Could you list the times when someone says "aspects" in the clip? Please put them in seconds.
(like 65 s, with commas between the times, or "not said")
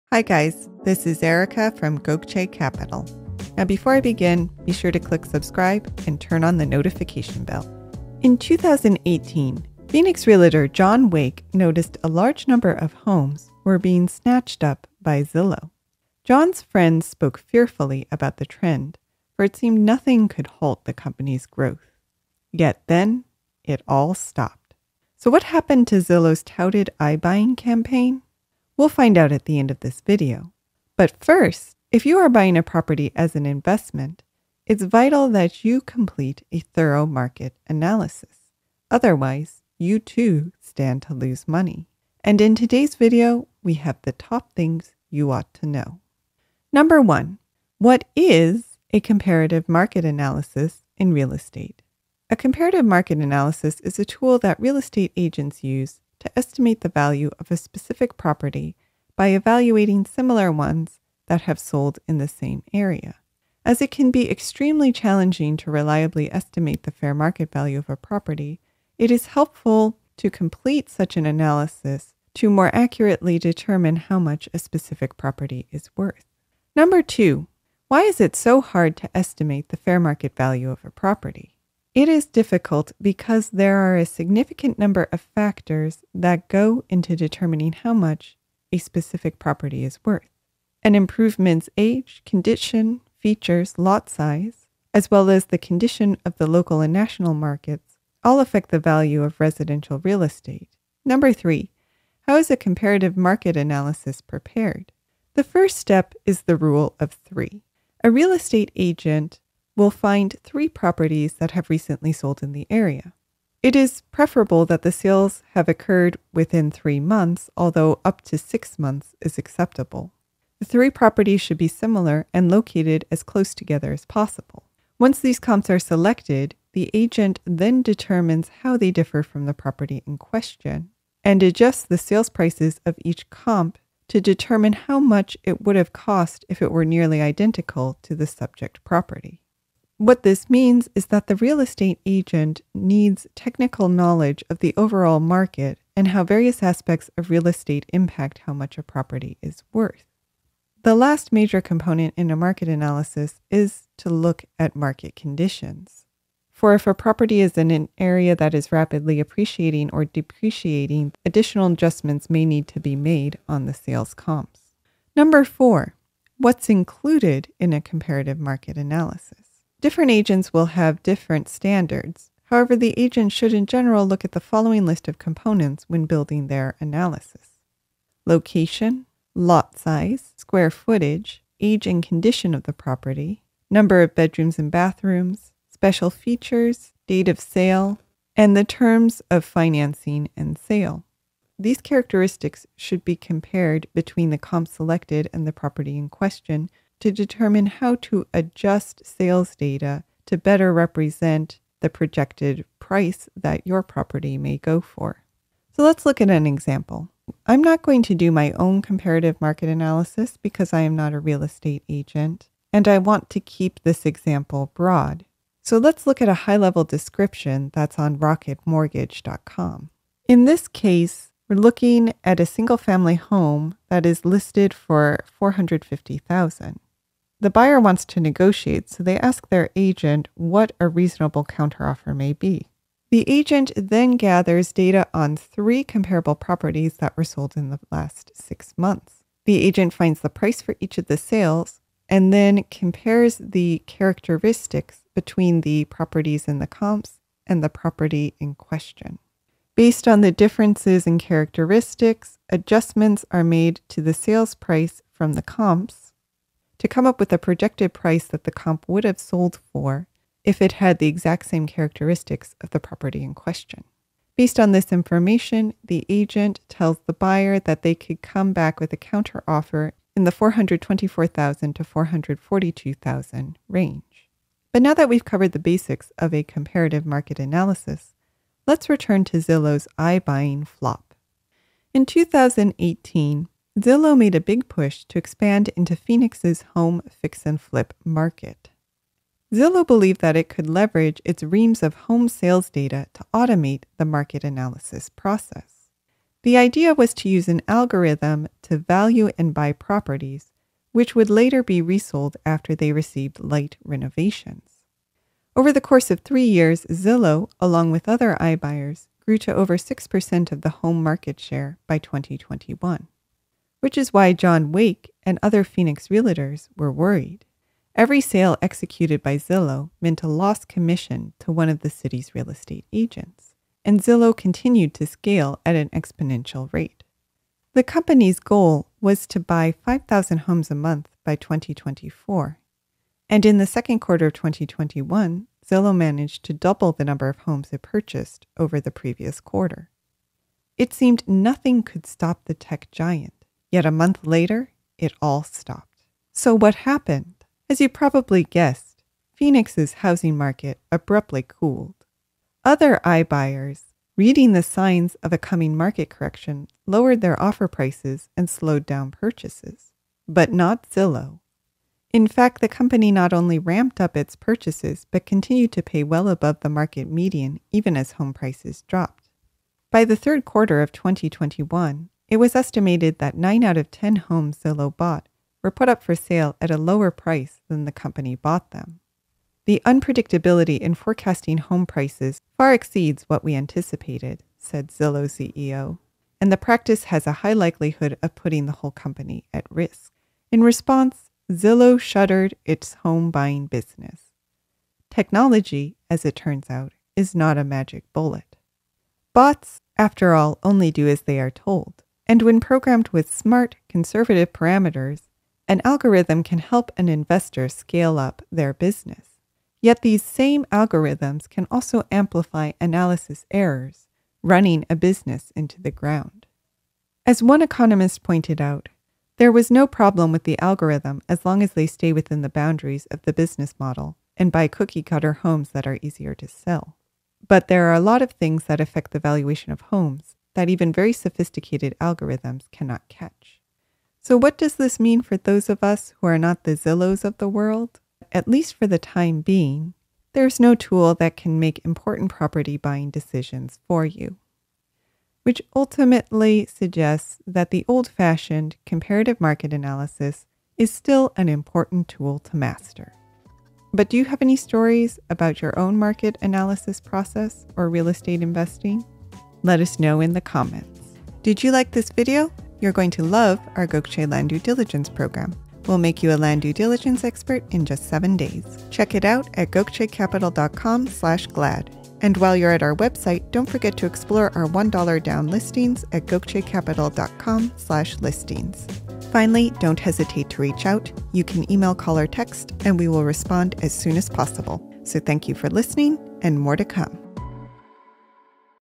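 146 s.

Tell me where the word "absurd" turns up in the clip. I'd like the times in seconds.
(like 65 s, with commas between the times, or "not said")
not said.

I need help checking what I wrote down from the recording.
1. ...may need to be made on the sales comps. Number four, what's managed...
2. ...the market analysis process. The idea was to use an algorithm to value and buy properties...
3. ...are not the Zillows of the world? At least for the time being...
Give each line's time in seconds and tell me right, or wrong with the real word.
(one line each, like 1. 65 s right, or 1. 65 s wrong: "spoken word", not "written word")
1. 162 s wrong: "included", not "managed"
2. 293 s right
3. 436 s right.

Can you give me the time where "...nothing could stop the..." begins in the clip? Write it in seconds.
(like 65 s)
341 s.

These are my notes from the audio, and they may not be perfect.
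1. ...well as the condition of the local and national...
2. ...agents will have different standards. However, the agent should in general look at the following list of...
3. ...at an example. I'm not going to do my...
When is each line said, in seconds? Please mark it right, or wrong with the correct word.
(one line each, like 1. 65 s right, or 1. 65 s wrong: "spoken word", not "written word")
1. 95 s right
2. 170 s right
3. 206 s right.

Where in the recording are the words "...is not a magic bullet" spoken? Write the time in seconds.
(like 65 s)
397 s.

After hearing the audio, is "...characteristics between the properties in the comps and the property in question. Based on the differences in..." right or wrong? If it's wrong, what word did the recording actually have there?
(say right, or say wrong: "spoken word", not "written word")
right.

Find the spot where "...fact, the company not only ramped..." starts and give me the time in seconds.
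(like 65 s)
362 s.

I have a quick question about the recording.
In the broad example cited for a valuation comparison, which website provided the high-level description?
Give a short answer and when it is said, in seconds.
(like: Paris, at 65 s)
rocketmortgage.com, at 218 s.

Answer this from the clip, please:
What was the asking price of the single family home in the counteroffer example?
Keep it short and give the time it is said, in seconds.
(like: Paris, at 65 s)
450,000, at 225 s.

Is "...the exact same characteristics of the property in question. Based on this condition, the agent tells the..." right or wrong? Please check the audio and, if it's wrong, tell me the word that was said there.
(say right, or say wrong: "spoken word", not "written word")
wrong: "information", not "condition".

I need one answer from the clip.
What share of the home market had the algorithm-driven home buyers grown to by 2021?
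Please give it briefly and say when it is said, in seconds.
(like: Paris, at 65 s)
6%, at 309 s.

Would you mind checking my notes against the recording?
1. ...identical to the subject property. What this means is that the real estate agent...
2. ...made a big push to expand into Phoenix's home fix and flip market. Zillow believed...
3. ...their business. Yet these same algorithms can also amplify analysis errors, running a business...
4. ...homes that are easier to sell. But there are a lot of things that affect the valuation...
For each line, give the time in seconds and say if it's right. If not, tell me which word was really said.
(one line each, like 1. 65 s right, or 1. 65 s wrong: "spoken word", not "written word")
1. 137 s right
2. 284 s right
3. 408 s right
4. 425 s right.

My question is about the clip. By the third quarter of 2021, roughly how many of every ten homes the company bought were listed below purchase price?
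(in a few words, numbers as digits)
9.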